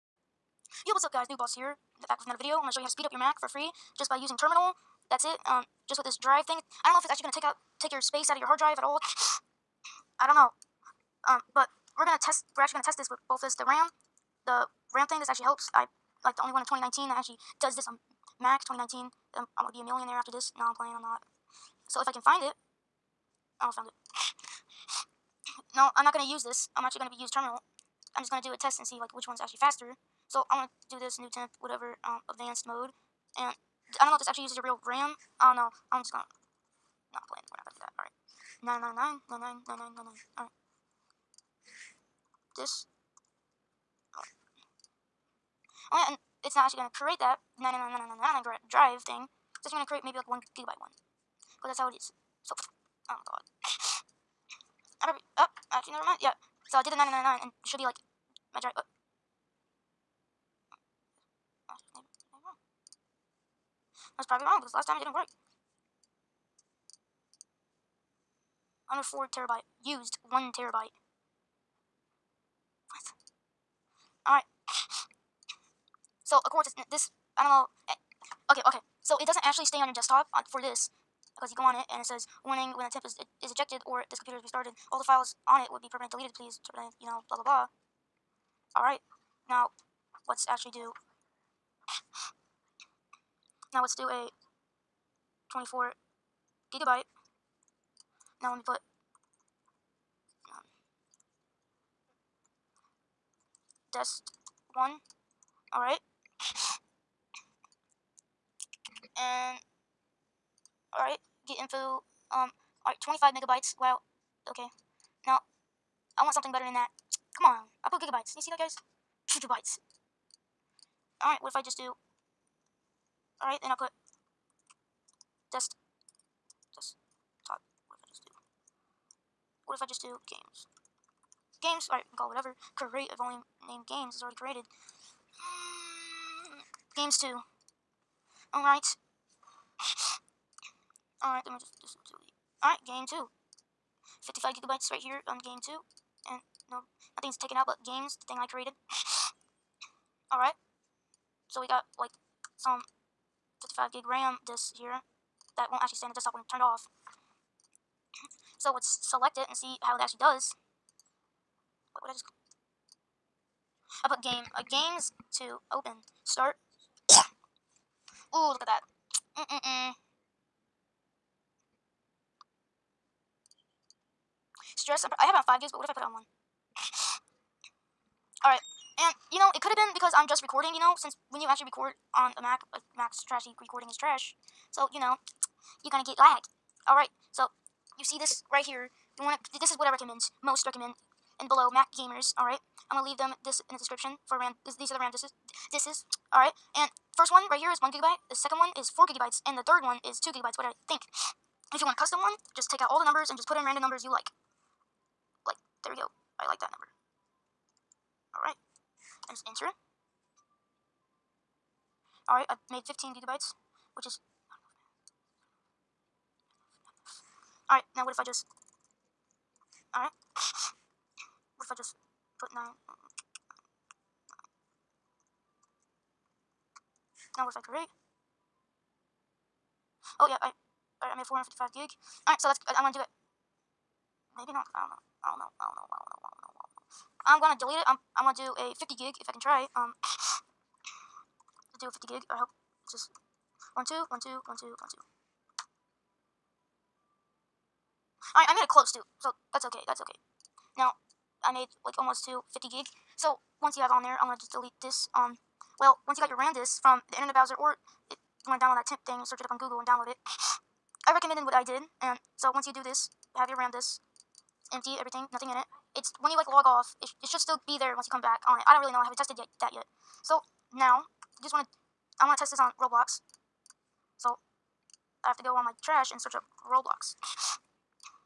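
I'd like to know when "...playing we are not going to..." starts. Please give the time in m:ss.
0:38.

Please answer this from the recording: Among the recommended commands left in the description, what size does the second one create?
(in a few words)
4 gigabytes.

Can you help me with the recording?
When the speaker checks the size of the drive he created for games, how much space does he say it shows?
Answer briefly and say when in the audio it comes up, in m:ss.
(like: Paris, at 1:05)
55 gigabytes, at 2:24.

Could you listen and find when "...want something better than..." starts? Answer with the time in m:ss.
1:56.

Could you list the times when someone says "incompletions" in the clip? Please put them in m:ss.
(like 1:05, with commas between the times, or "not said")
not said.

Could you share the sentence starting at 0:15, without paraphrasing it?
I like the only one in 2019 that actually does this on Mac 2019.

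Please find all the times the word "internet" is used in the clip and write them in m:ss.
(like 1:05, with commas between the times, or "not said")
4:17.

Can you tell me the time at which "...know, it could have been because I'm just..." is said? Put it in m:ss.
2:59.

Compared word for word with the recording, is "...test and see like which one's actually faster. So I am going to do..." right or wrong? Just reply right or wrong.
right.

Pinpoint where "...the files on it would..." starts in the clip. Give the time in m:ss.
1:24.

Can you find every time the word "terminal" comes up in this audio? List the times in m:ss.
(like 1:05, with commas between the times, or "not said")
0:04, 0:27.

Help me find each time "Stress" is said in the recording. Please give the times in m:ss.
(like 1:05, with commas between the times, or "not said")
2:54.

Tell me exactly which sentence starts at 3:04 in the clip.
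So, you know, you're gonna get lag.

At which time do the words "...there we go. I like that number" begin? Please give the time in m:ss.
3:25.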